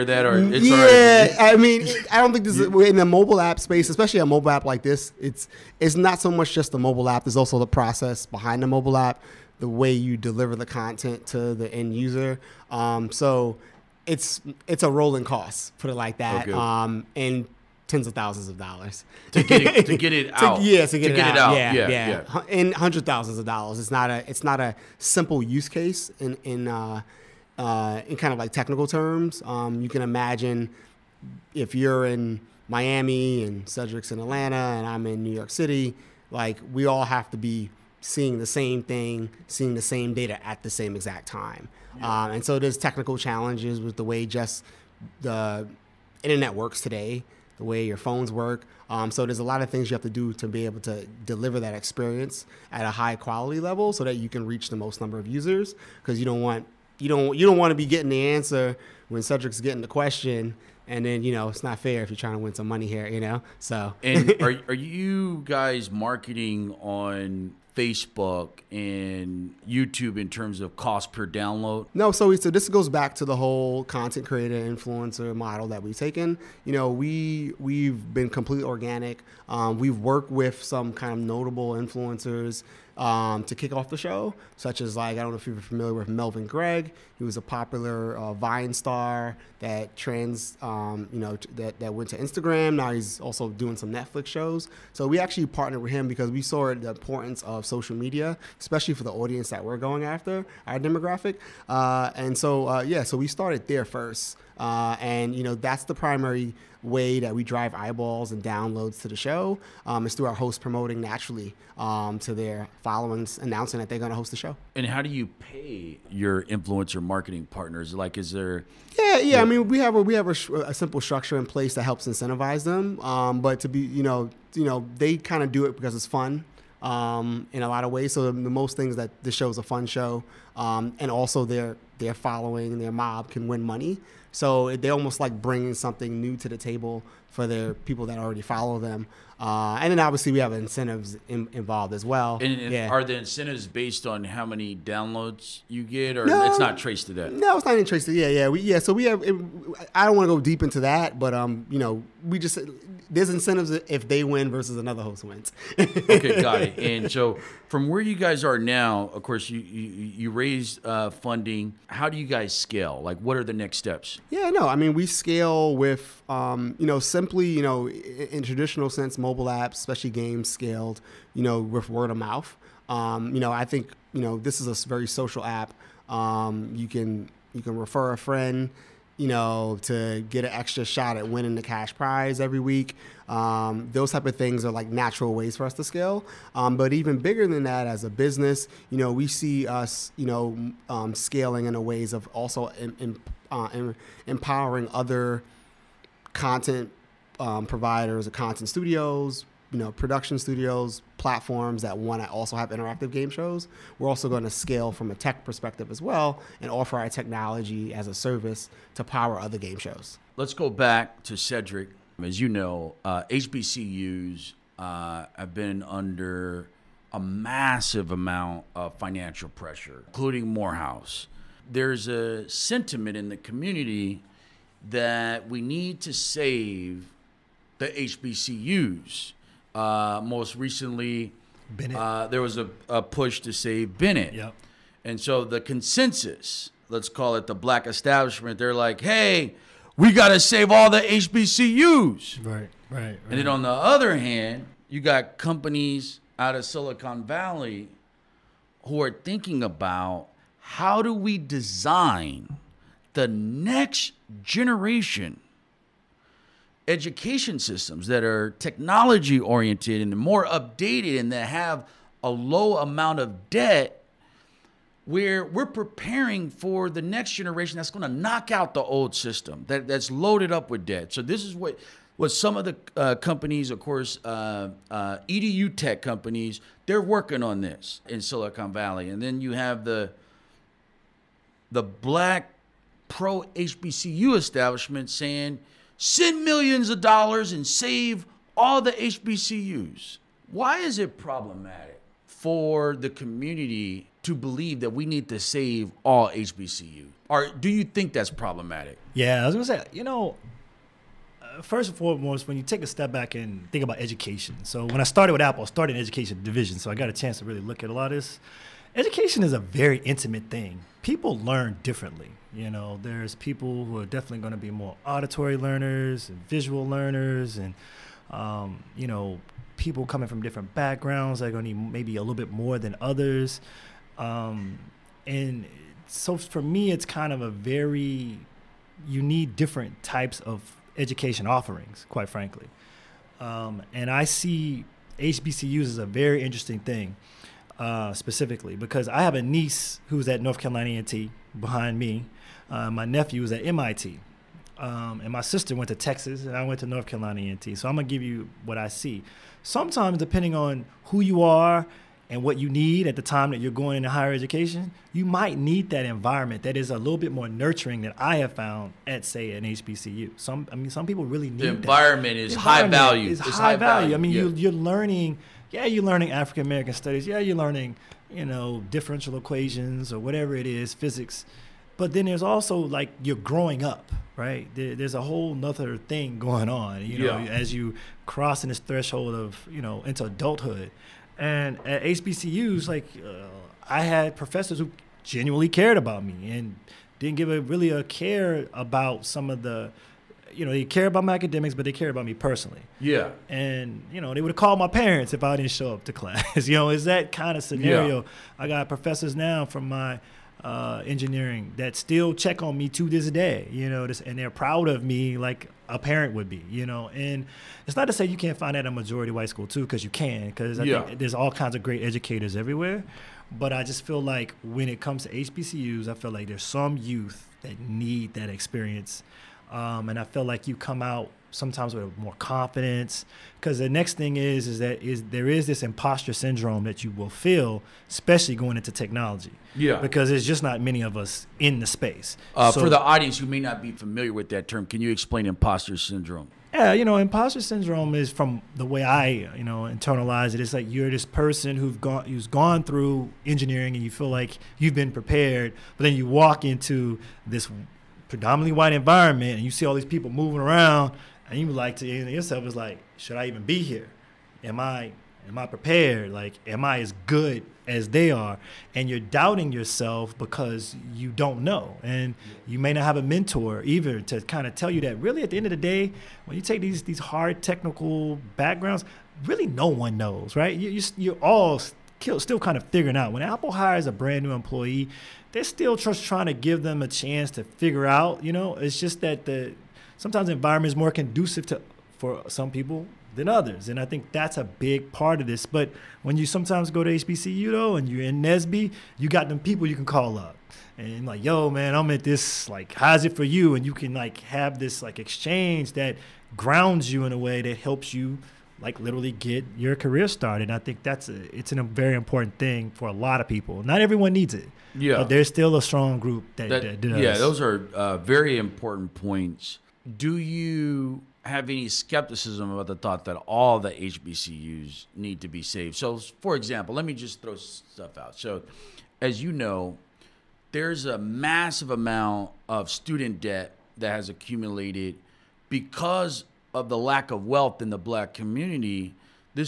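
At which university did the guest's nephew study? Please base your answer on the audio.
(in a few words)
MIT.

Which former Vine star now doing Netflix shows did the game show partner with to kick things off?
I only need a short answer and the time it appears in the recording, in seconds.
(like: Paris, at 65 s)
Melvin Gregg, at 86 s.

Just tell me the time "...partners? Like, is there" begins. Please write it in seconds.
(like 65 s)
117 s.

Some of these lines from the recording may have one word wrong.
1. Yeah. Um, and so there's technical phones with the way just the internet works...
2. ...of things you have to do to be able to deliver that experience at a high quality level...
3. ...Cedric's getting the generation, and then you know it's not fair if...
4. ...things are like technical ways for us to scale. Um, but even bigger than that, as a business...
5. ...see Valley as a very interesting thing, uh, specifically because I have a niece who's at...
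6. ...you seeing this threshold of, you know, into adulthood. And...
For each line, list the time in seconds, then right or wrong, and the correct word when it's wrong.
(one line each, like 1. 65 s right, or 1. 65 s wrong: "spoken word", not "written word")
1. 41 s wrong: "challenges", not "phones"
2. 49 s right
3. 59 s wrong: "question", not "generation"
4. 184 s wrong: "natural", not "technical"
5. 334 s wrong: "HBCUs", not "Valley"
6. 377 s wrong: "crossing", not "seeing".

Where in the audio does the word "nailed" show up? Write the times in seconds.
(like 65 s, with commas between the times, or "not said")
not said.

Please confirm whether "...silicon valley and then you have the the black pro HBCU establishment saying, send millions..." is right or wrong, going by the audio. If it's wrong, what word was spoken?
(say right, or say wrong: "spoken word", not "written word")
right.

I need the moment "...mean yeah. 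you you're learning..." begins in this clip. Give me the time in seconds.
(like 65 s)
364 s.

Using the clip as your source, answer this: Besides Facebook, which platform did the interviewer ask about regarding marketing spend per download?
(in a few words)
YouTube.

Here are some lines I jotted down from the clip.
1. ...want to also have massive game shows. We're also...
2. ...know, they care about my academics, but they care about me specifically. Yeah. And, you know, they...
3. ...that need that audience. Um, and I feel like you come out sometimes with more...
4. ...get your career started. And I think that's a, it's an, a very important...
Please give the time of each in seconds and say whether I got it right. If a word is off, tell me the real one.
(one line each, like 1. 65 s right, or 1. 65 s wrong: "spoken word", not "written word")
1. 201 s wrong: "interactive", not "massive"
2. 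390 s wrong: "personally", not "specifically"
3. 417 s wrong: "experience", not "audience"
4. 499 s right.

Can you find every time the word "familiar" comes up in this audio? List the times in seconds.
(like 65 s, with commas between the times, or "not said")
85 s, 433 s.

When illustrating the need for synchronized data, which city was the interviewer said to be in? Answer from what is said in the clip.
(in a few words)
Miami.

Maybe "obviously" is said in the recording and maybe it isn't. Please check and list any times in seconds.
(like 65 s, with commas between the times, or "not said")
139 s.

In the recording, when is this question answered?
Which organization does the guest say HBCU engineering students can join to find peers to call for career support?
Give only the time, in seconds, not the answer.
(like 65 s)
488 s.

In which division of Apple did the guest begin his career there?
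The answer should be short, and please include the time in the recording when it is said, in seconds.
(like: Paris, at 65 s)
education division, at 306 s.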